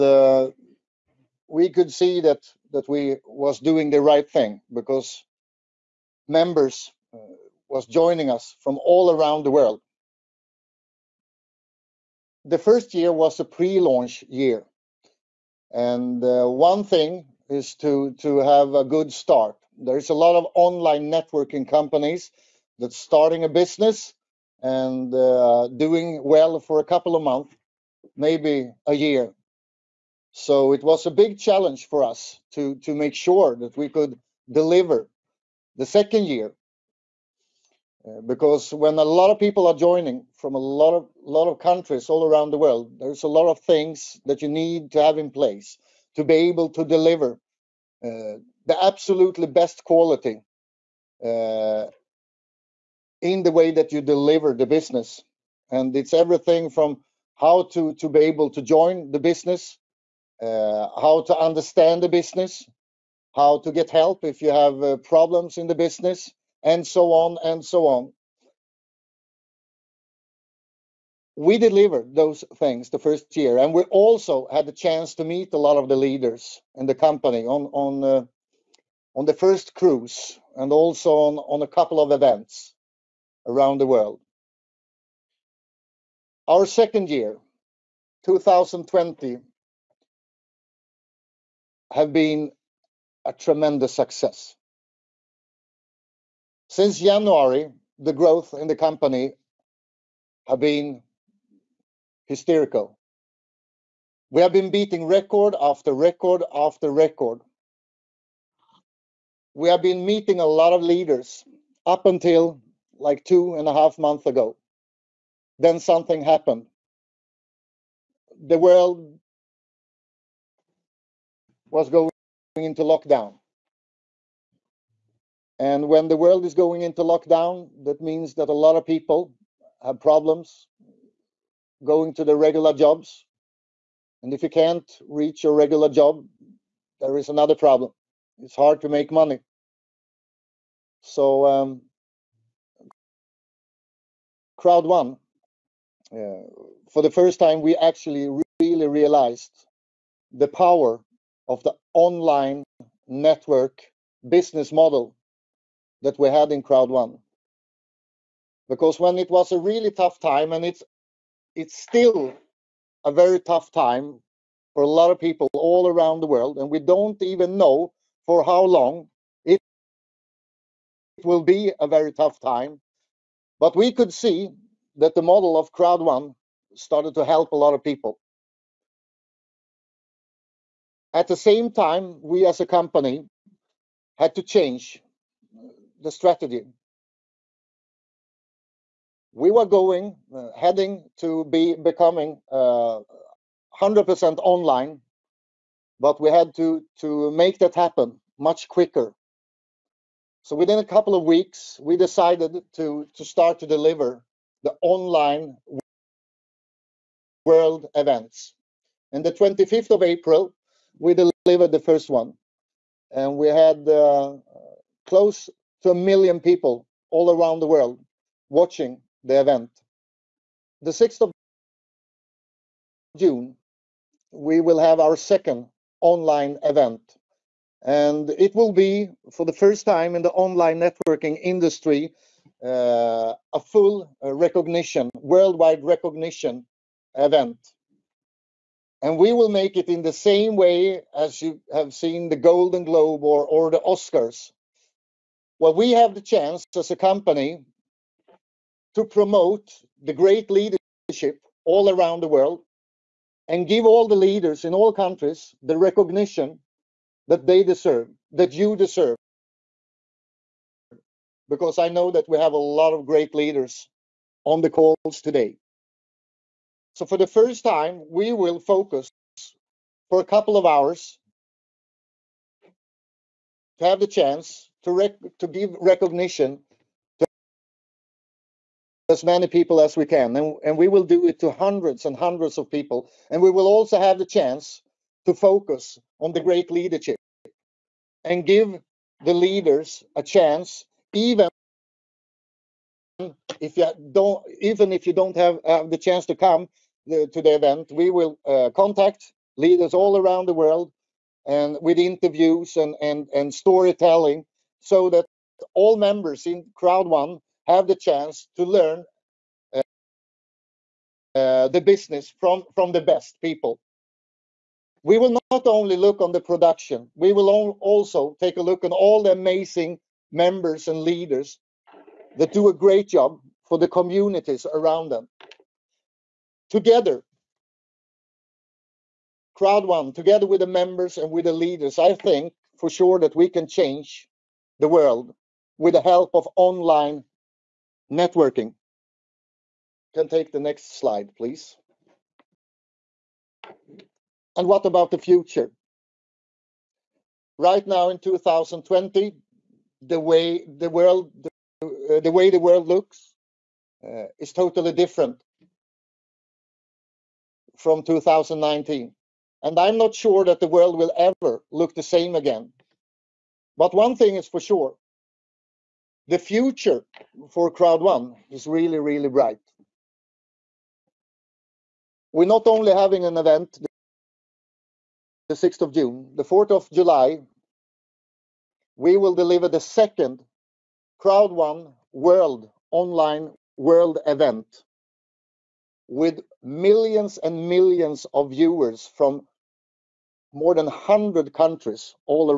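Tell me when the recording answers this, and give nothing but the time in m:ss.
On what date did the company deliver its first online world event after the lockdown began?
3:29.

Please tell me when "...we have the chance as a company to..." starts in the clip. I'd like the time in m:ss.
4:05.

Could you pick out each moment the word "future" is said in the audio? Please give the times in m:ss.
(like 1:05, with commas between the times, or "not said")
5:45, 6:06.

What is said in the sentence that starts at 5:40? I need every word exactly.
Can take the next slide, please.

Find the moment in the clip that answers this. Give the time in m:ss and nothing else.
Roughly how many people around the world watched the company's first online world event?
3:35.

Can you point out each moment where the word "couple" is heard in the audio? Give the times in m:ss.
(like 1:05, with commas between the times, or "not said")
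0:26, 1:21, 3:20, 4:30.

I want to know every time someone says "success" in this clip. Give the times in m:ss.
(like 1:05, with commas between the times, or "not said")
1:33.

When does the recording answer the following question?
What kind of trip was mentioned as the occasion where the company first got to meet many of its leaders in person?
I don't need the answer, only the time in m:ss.
1:19.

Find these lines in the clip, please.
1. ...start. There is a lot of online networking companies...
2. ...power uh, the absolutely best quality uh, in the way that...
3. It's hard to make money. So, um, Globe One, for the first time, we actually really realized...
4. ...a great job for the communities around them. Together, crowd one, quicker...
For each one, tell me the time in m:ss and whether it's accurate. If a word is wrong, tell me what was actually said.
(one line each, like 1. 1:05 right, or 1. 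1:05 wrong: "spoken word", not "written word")
1. 0:19 right
2. 0:46 wrong: "deliver", not "power"
3. 2:18 wrong: "Crowd", not "Globe"
4. 5:22 wrong: "together", not "quicker".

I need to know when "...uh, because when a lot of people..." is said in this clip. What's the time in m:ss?
0:38.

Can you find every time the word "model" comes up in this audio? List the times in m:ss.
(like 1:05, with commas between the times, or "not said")
2:34, 2:55.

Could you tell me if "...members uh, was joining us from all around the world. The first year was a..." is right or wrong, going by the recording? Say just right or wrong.
right.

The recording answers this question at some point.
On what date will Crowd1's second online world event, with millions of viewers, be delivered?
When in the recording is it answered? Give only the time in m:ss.
6:16.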